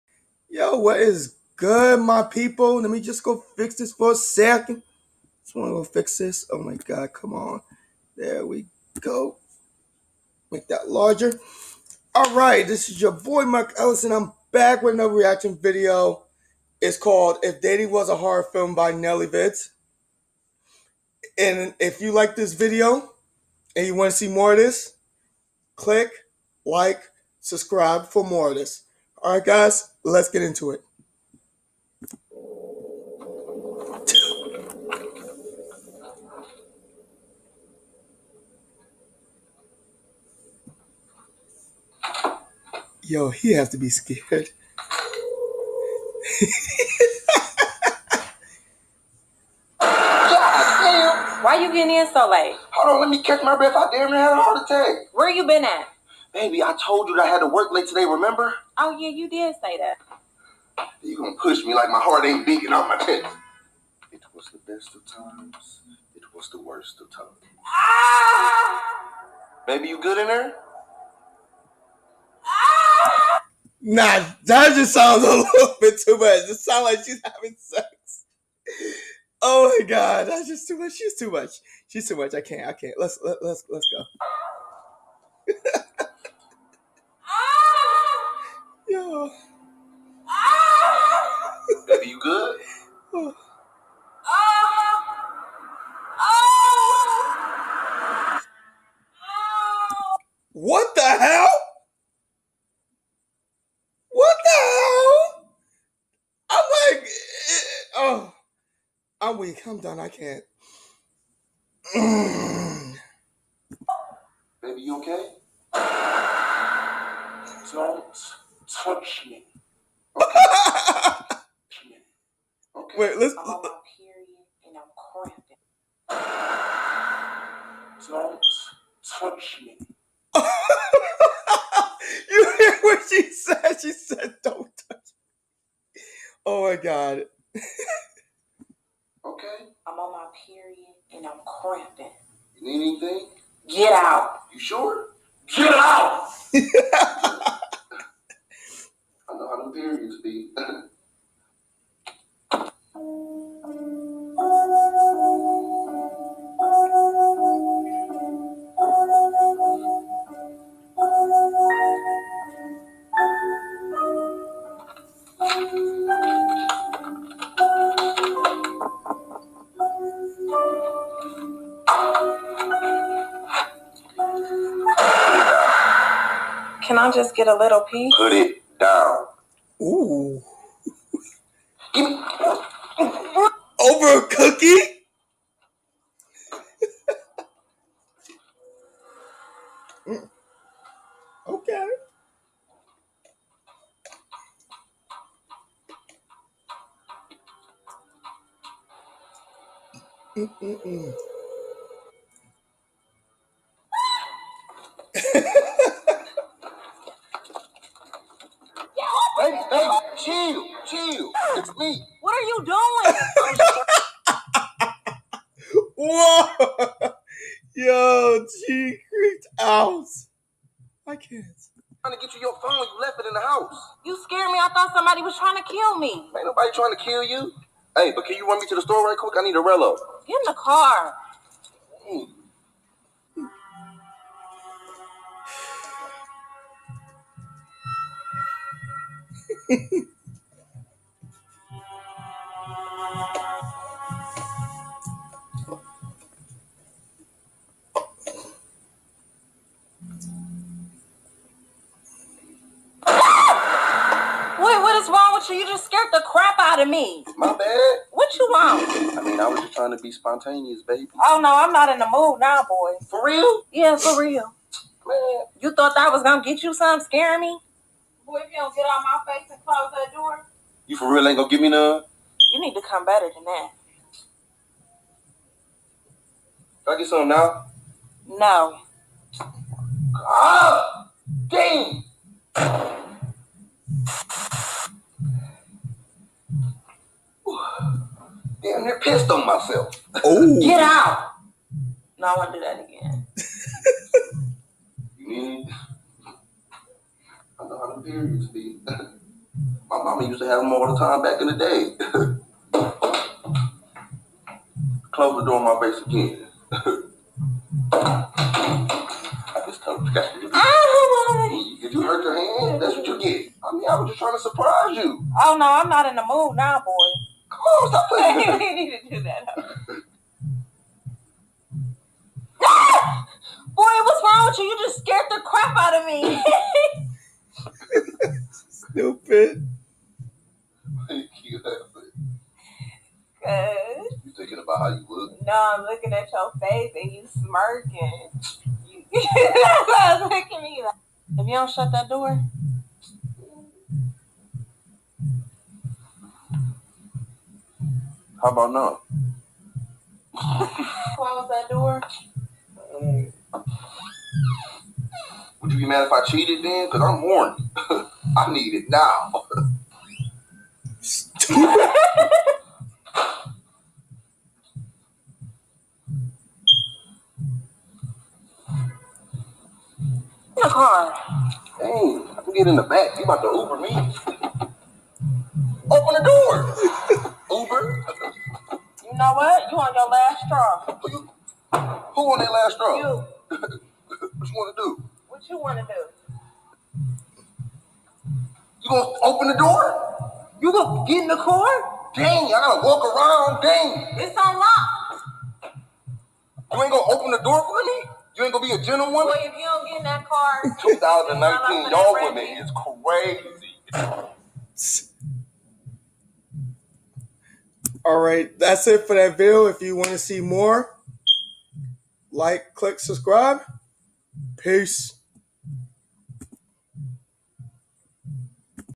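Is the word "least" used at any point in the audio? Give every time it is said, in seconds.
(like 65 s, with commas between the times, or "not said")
not said.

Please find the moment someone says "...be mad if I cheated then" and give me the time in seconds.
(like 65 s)
355 s.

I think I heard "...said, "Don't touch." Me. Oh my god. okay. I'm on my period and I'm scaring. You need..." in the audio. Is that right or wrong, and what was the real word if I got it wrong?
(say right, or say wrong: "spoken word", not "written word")
wrong: "cramping", not "scaring".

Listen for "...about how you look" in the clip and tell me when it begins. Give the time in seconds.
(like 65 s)
334 s.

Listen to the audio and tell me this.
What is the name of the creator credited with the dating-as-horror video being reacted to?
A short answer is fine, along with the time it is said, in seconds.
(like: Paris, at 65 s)
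NellyVidz, at 18 s.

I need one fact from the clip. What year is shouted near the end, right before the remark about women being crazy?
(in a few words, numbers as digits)
2019.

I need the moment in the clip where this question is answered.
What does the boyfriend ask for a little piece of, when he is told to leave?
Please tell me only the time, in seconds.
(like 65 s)
184 s.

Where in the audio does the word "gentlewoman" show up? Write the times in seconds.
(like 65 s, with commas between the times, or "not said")
398 s.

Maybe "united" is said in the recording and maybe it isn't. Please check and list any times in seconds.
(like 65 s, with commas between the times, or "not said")
not said.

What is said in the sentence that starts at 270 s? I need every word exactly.
You for real ain't gonna give me none?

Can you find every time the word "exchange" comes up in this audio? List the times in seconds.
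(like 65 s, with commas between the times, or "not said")
not said.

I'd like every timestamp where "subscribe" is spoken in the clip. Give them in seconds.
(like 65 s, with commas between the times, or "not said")
27 s, 412 s.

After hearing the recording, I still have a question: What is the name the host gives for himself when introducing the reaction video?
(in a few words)
Mark Ellison.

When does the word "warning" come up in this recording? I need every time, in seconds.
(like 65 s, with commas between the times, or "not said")
357 s.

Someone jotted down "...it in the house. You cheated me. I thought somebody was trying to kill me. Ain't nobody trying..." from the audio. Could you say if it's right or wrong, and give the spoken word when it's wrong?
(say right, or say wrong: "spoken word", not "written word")
wrong: "scared", not "cheated".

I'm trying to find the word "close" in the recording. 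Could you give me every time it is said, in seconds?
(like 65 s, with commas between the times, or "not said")
269 s, 305 s, 350 s.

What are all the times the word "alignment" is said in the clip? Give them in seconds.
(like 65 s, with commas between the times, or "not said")
not said.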